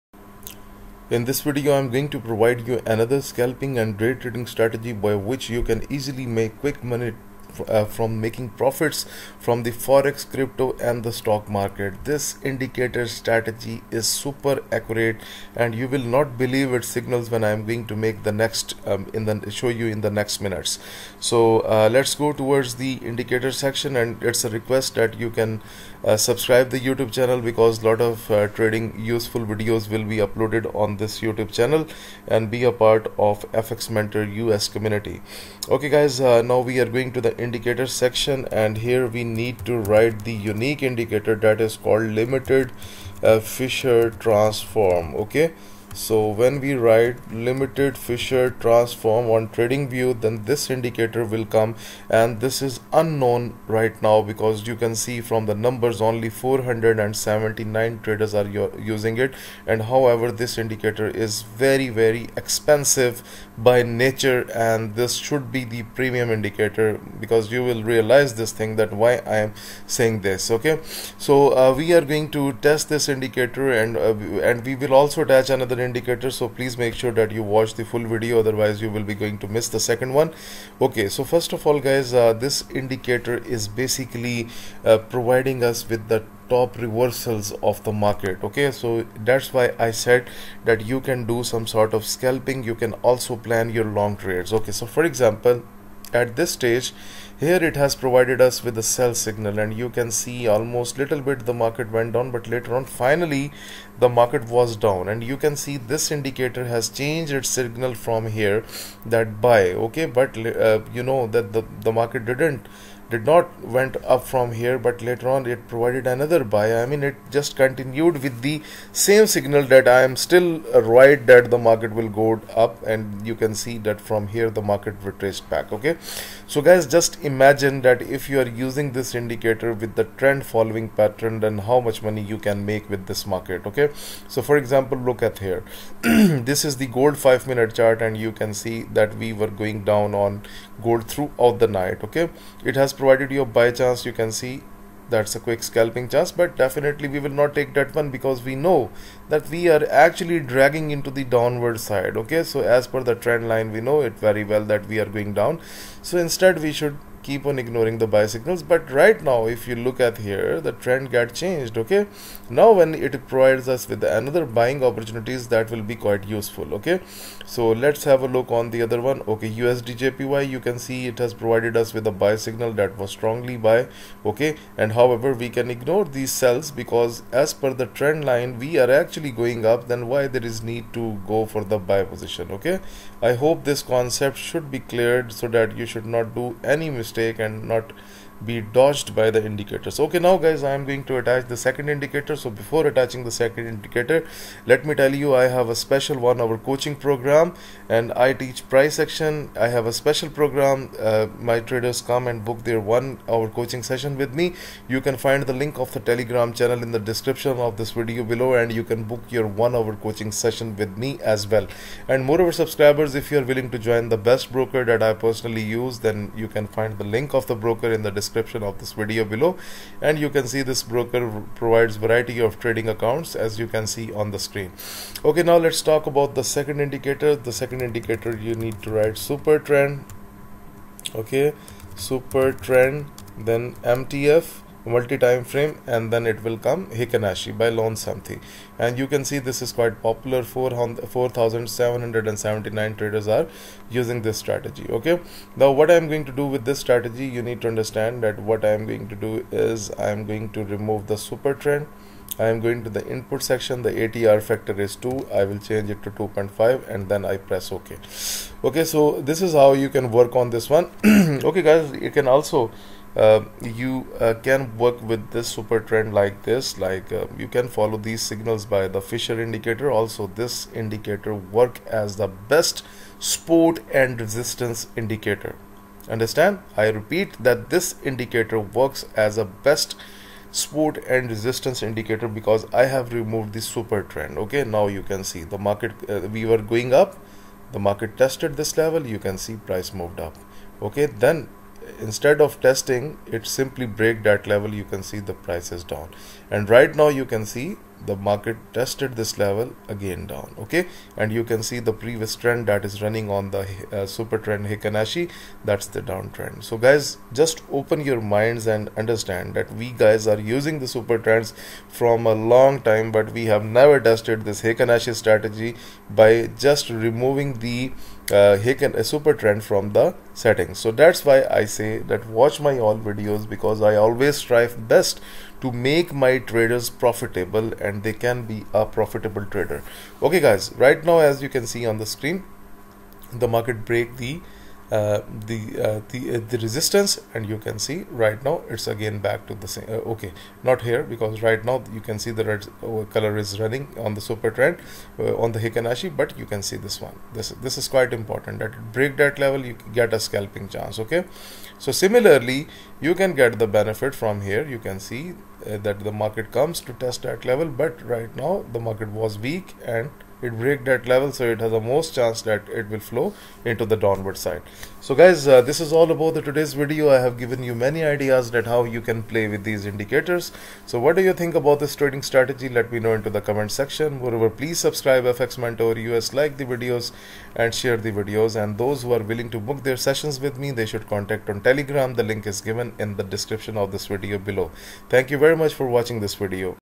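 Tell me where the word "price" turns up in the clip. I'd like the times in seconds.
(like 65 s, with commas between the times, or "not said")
198 s, 289 s, 295 s.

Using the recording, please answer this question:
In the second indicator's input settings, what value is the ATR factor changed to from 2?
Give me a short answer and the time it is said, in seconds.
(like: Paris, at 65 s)
2.5, at 256 s.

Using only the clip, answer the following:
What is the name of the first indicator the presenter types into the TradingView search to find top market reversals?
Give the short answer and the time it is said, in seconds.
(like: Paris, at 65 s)
Limited Fisher Transform, at 42 s.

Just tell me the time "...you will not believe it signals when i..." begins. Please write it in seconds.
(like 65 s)
15 s.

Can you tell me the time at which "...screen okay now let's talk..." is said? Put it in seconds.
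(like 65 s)
224 s.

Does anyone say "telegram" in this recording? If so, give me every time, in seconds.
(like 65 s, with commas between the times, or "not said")
205 s, 381 s.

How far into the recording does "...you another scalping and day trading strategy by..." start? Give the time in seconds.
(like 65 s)
2 s.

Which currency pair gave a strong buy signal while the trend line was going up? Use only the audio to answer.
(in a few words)
USDJPY.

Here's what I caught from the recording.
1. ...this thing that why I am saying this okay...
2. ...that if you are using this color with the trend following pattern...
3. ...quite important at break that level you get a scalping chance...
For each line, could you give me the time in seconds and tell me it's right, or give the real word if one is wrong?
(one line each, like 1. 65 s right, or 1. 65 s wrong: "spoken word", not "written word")
1. 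68 s right
2. 127 s wrong: "indicator", not "color"
3. 347 s right.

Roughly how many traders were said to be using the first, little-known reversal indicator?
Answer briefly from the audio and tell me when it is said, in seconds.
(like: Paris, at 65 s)
479, at 56 s.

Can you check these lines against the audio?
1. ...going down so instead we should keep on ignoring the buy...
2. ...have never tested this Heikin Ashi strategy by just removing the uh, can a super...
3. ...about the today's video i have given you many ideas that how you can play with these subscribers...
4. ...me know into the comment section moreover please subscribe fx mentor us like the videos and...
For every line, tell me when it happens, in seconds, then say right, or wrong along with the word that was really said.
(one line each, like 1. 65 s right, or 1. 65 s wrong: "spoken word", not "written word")
1. 155 s right
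2. 313 s right
3. 366 s wrong: "indicators", not "subscribers"
4. 372 s right.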